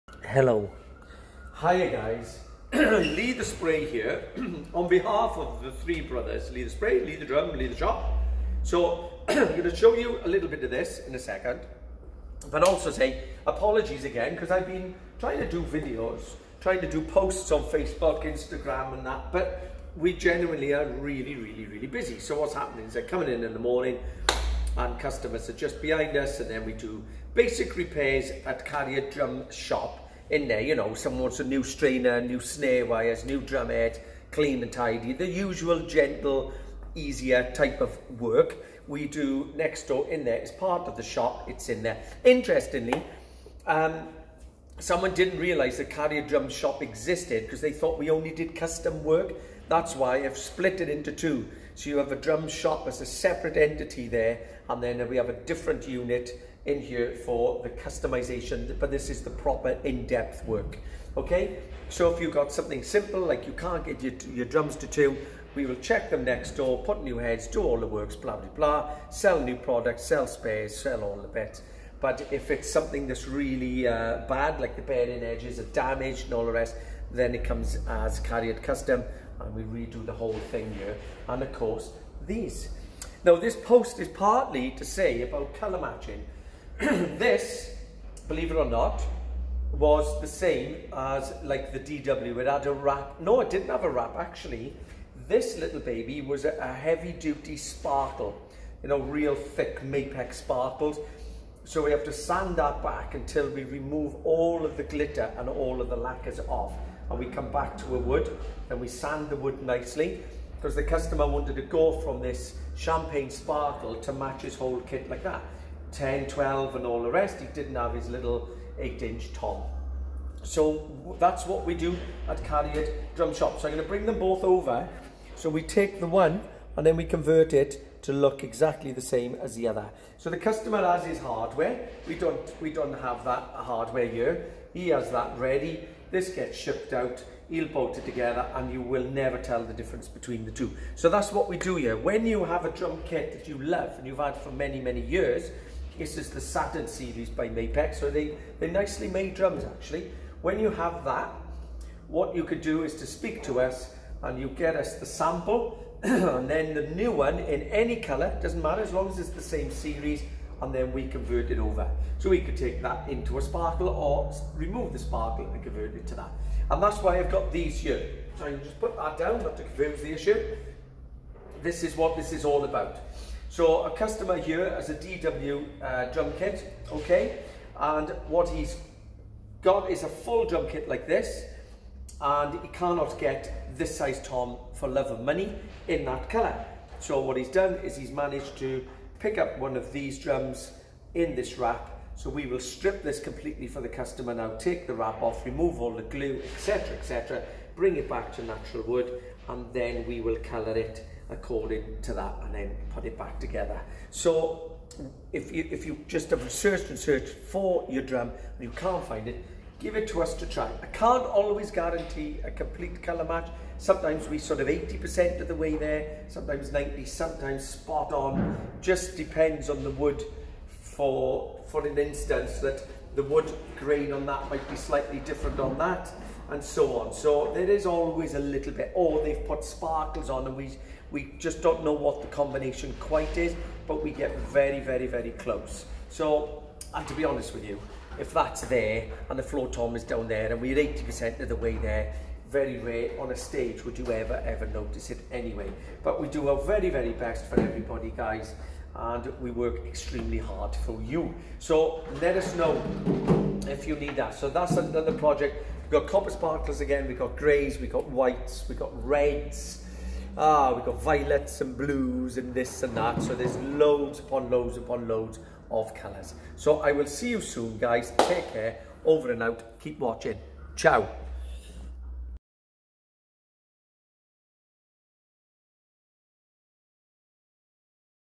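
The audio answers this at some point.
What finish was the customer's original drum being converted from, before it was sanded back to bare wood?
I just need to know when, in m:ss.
1:52.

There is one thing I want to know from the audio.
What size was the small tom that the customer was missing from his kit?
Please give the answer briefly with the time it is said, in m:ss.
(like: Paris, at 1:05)
8 inch, at 1:58.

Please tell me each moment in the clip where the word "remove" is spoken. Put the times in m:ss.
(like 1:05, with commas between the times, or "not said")
1:43, 2:44, 3:15.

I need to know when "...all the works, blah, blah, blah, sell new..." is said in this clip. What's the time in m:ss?
1:07.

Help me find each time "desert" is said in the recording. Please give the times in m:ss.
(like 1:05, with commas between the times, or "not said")
not said.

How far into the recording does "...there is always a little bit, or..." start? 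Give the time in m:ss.
3:47.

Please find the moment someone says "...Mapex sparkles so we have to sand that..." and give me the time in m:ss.
1:39.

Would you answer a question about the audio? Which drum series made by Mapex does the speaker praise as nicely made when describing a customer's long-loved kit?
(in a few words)
Saturn series.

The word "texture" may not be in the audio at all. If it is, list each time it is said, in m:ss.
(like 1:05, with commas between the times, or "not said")
not said.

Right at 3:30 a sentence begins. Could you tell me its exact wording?
I can't always guarantee a complete colour match.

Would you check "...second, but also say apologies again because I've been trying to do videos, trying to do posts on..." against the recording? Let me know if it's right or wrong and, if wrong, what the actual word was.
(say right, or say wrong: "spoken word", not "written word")
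right.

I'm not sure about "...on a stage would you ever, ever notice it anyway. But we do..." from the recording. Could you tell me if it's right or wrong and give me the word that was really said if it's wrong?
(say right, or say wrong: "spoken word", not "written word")
right.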